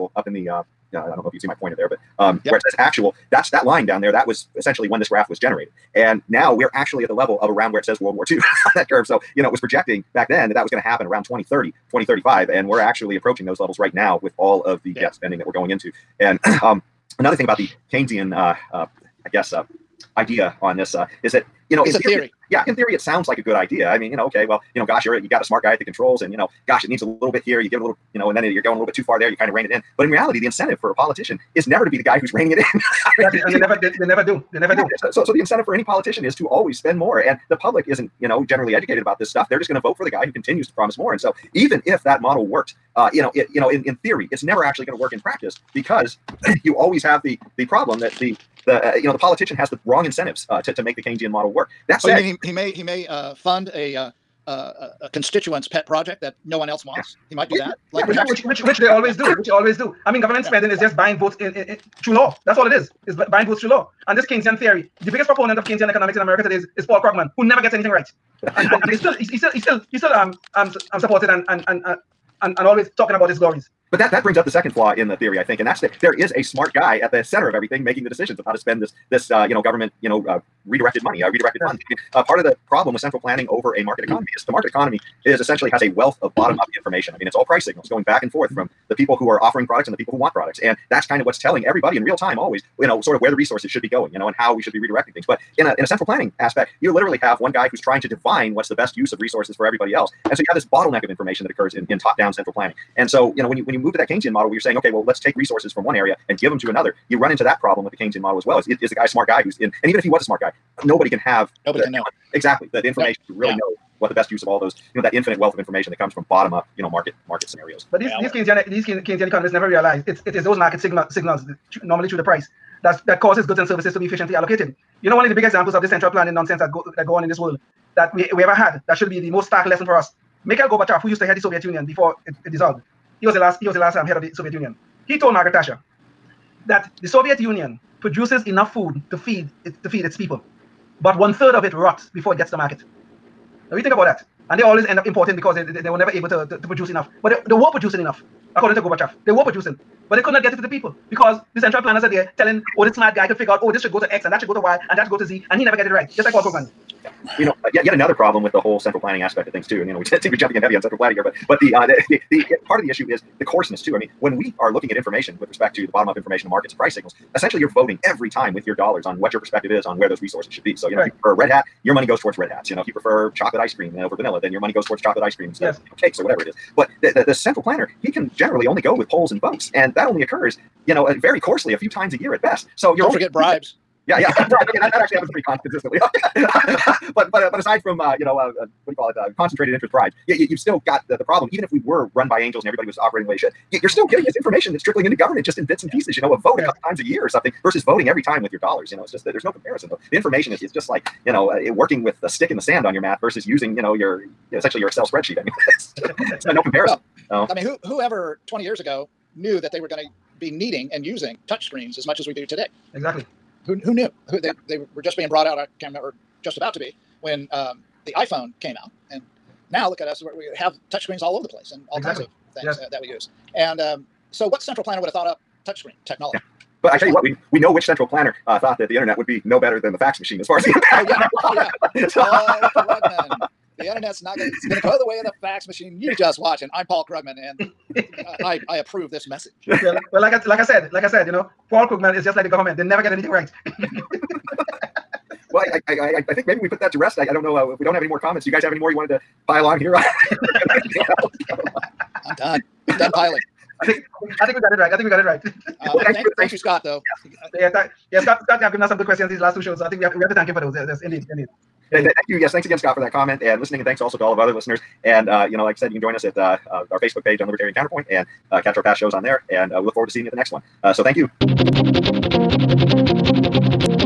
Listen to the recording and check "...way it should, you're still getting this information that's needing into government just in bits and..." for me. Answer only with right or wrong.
wrong.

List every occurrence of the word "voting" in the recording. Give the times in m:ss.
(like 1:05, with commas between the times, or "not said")
2:47, 3:17.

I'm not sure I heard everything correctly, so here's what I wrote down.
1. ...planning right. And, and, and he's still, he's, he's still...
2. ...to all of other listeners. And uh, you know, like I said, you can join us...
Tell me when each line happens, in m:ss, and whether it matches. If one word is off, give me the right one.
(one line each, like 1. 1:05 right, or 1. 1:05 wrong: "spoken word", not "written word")
1. 1:07 wrong: "anything", not "planning"
2. 4:24 right.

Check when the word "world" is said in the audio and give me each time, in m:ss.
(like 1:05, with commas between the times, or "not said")
0:08, 2:07.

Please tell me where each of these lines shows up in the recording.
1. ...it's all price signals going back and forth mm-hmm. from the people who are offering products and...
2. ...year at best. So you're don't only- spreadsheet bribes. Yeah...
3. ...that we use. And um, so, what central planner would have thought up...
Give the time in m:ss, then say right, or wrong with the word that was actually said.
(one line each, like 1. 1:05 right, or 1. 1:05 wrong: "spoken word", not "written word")
1. 1:27 right
2. 3:02 wrong: "forget", not "spreadsheet"
3. 3:42 right.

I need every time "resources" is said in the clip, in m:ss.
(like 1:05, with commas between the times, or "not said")
1:33, 1:39, 1:45, 2:50.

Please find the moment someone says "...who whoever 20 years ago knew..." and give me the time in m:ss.
3:27.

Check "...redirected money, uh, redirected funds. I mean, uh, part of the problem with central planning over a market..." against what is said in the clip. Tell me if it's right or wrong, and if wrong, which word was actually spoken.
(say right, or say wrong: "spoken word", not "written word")
right.